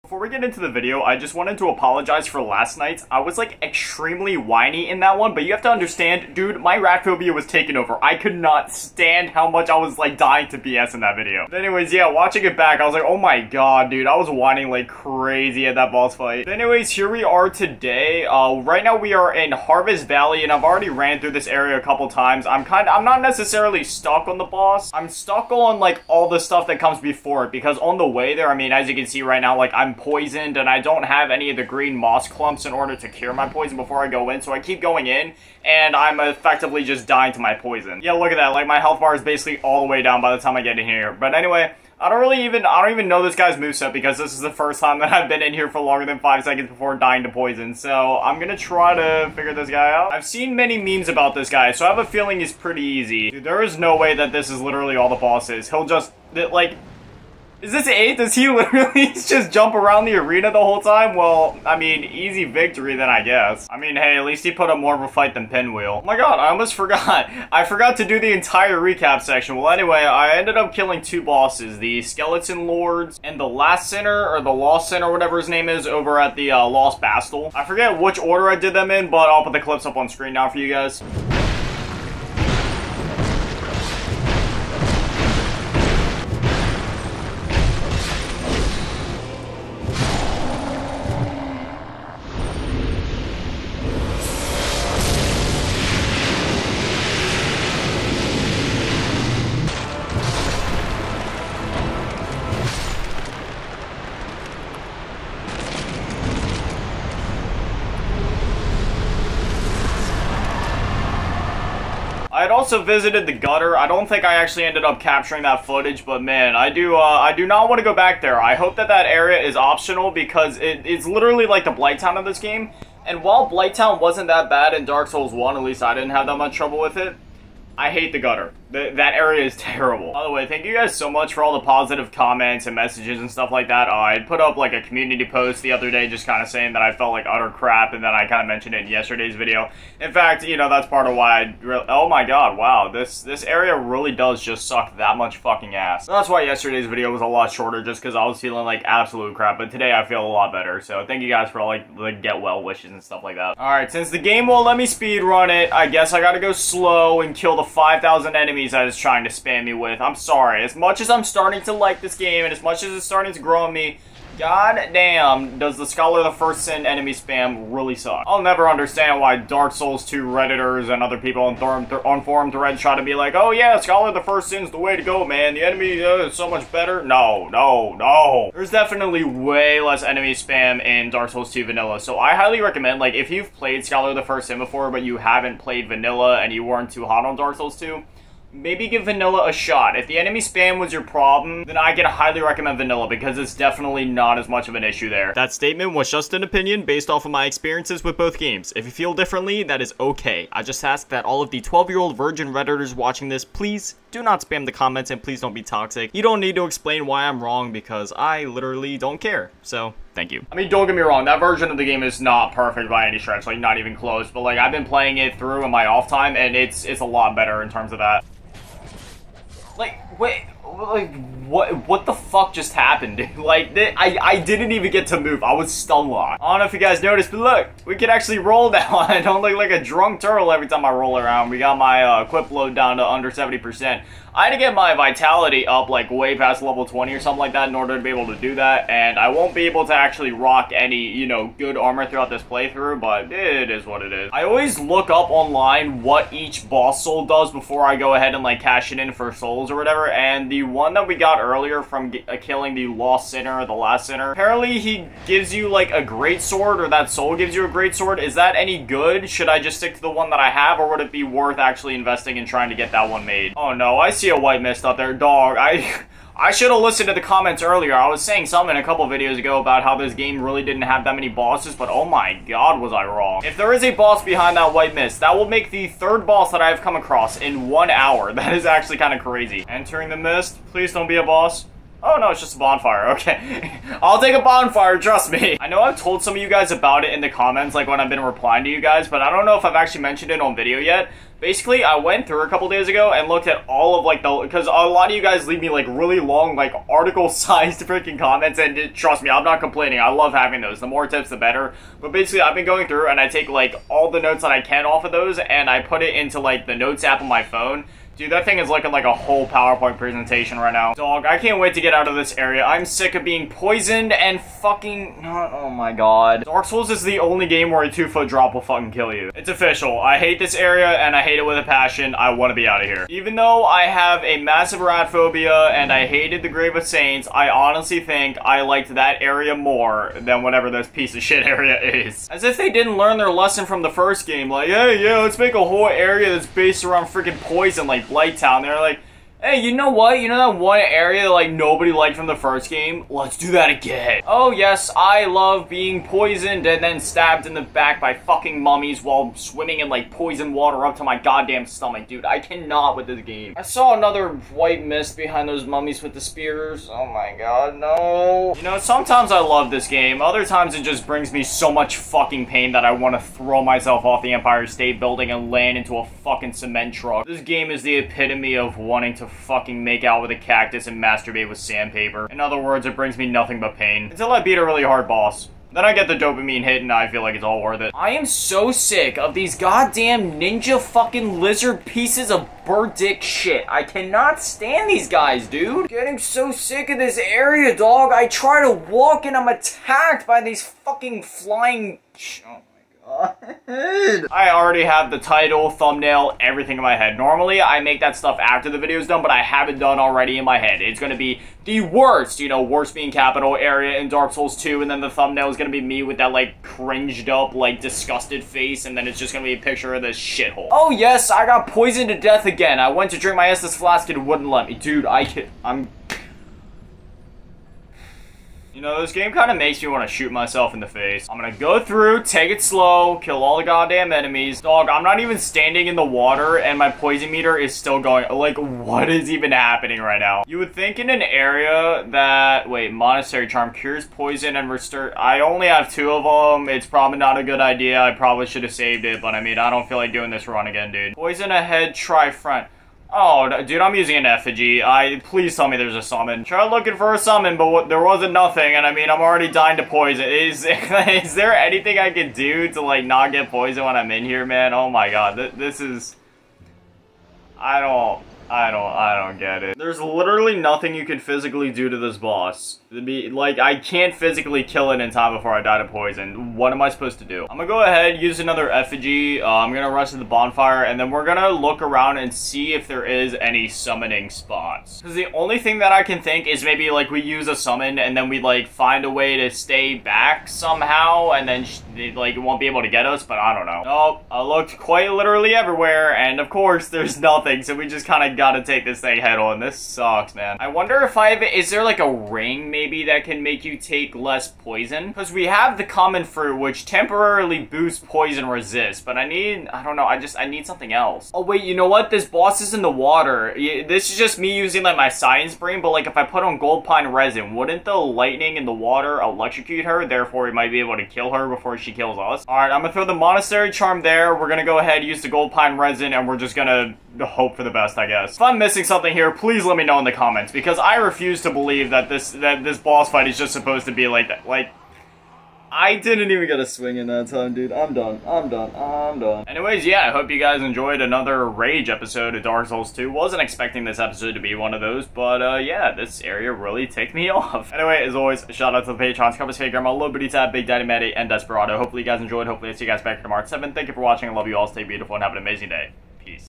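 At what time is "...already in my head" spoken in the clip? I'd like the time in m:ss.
6:39.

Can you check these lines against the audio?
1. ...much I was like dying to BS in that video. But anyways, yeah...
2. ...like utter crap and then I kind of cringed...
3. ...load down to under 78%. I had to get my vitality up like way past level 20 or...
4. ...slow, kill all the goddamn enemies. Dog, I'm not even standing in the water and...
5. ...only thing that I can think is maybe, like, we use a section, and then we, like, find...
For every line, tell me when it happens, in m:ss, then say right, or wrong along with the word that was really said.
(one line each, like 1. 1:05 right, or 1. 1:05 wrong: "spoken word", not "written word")
1. 0:09 right
2. 2:17 wrong: "mentioned", not "cringed"
3. 3:52 wrong: "70", not "78"
4. 7:02 right
5. 7:55 wrong: "summon", not "section".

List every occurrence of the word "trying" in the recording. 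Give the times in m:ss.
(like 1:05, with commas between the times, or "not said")
2:38, 4:22.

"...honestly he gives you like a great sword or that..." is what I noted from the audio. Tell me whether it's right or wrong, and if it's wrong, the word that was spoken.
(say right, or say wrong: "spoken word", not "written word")
wrong: "apparently", not "honestly".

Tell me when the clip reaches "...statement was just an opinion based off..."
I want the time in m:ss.
3:15.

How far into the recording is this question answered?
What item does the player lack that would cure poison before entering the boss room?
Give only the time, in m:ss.
0:31.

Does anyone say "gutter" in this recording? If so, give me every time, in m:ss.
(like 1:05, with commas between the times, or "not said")
1:53, 2:08.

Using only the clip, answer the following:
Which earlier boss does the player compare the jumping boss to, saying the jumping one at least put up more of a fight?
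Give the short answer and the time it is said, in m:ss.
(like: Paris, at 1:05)
Pinwheel, at 1:05.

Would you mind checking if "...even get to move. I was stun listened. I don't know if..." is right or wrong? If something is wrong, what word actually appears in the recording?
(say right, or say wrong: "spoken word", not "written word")
wrong: "locked", not "listened".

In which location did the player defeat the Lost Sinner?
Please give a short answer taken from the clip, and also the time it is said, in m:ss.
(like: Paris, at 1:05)
Lost Bastille, at 1:16.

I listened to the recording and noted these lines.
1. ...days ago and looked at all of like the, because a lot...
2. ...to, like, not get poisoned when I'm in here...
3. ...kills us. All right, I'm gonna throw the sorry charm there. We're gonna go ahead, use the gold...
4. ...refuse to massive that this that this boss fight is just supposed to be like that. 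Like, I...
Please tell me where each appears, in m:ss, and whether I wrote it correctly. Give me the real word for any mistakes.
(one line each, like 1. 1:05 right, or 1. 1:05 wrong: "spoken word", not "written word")
1. 4:52 right
2. 7:32 right
3. 8:31 wrong: "monastery", not "sorry"
4. 8:40 wrong: "believe", not "massive".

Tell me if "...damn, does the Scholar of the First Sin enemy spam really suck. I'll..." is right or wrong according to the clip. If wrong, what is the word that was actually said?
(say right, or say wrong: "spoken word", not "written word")
right.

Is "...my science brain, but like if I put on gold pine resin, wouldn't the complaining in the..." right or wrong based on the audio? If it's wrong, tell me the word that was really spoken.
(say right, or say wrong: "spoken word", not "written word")
wrong: "lightning", not "complaining".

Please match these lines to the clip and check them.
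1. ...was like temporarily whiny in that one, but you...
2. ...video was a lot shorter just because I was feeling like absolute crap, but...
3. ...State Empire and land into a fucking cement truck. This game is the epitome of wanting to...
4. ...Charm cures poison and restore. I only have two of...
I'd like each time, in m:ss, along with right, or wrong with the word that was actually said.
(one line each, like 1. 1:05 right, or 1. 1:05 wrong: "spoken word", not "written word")
1. 0:03 wrong: "extremely", not "temporarily"
2. 2:26 right
3. 6:04 wrong: "Building", not "Empire"
4. 7:13 right.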